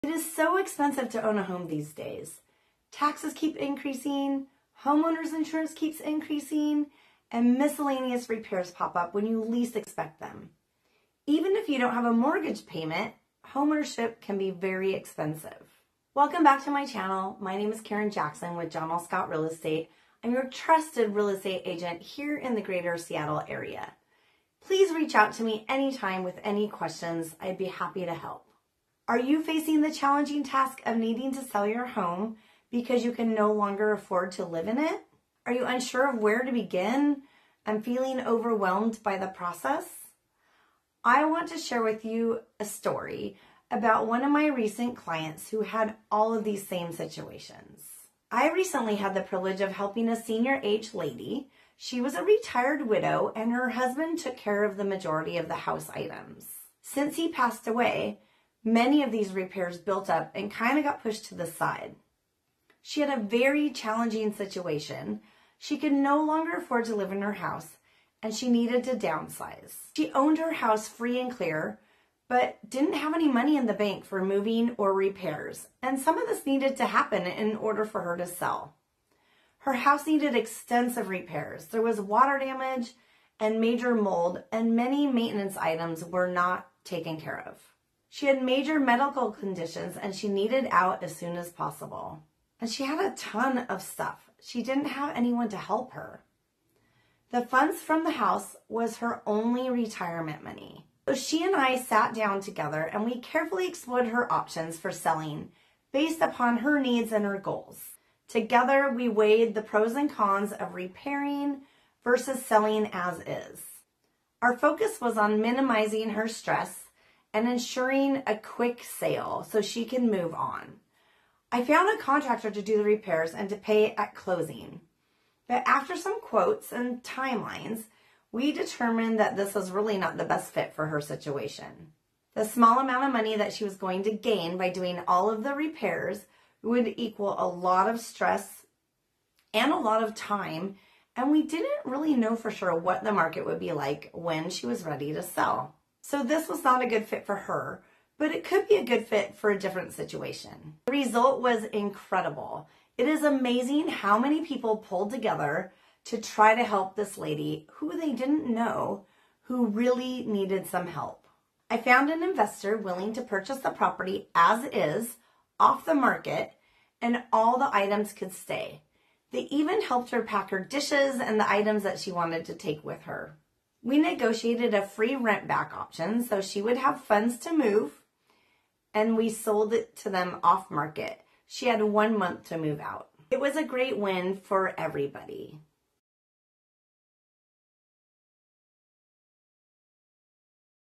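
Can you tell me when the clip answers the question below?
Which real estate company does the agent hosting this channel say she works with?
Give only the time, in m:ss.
0:18.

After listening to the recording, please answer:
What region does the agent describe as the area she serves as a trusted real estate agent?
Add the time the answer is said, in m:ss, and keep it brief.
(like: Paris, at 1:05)
greater Seattle area, at 0:22.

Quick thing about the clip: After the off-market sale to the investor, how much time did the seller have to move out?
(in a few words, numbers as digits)
one month.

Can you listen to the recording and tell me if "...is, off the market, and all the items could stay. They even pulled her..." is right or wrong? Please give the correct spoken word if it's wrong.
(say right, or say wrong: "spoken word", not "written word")
wrong: "helped", not "pulled".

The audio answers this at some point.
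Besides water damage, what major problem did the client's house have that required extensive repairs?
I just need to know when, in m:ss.
1:23.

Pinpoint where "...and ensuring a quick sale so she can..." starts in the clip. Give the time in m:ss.
1:57.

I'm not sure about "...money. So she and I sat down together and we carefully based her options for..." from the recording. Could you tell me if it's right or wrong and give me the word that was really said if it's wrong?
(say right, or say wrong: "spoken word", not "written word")
wrong: "explored", not "based".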